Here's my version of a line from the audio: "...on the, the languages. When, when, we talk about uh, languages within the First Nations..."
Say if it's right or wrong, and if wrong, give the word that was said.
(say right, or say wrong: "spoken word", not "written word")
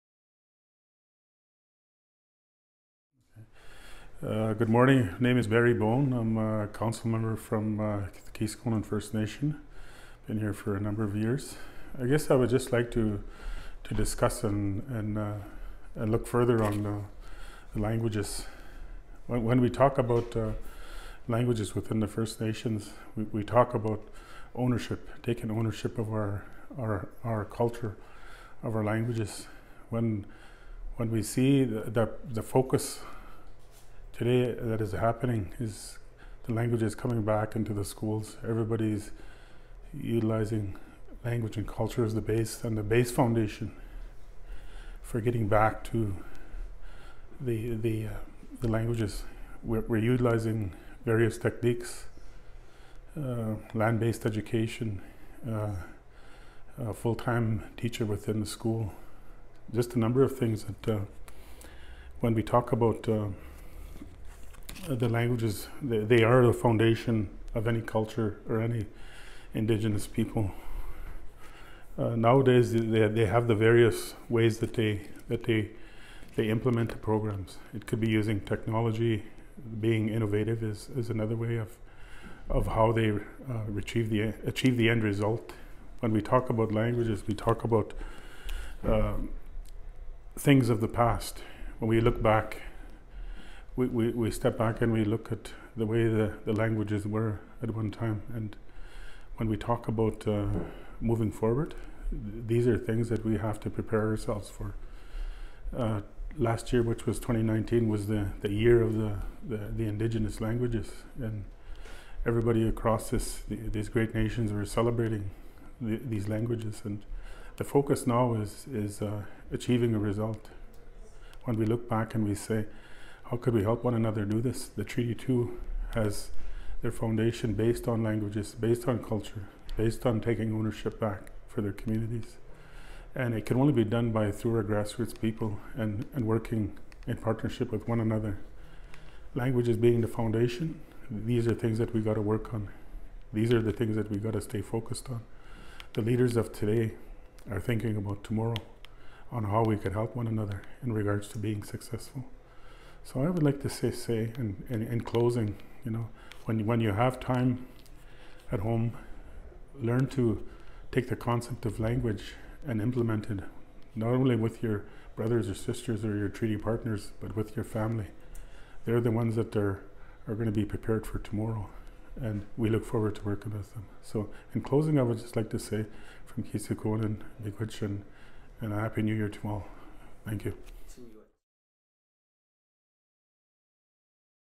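right.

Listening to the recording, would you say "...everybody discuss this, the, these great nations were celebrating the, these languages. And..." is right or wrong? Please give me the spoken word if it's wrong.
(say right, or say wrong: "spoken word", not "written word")
wrong: "across", not "discuss".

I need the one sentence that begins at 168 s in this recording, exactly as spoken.
They're the ones that are, are going to be prepared for tomorrow, and we look forward to working with them.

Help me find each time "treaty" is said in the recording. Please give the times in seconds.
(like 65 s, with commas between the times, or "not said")
124 s, 166 s.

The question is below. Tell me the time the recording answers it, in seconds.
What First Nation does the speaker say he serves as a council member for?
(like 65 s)
8 s.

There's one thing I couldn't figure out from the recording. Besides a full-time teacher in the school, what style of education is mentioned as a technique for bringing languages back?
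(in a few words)
Land-based education.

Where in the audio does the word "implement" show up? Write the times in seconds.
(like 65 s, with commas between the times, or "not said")
76 s, 162 s.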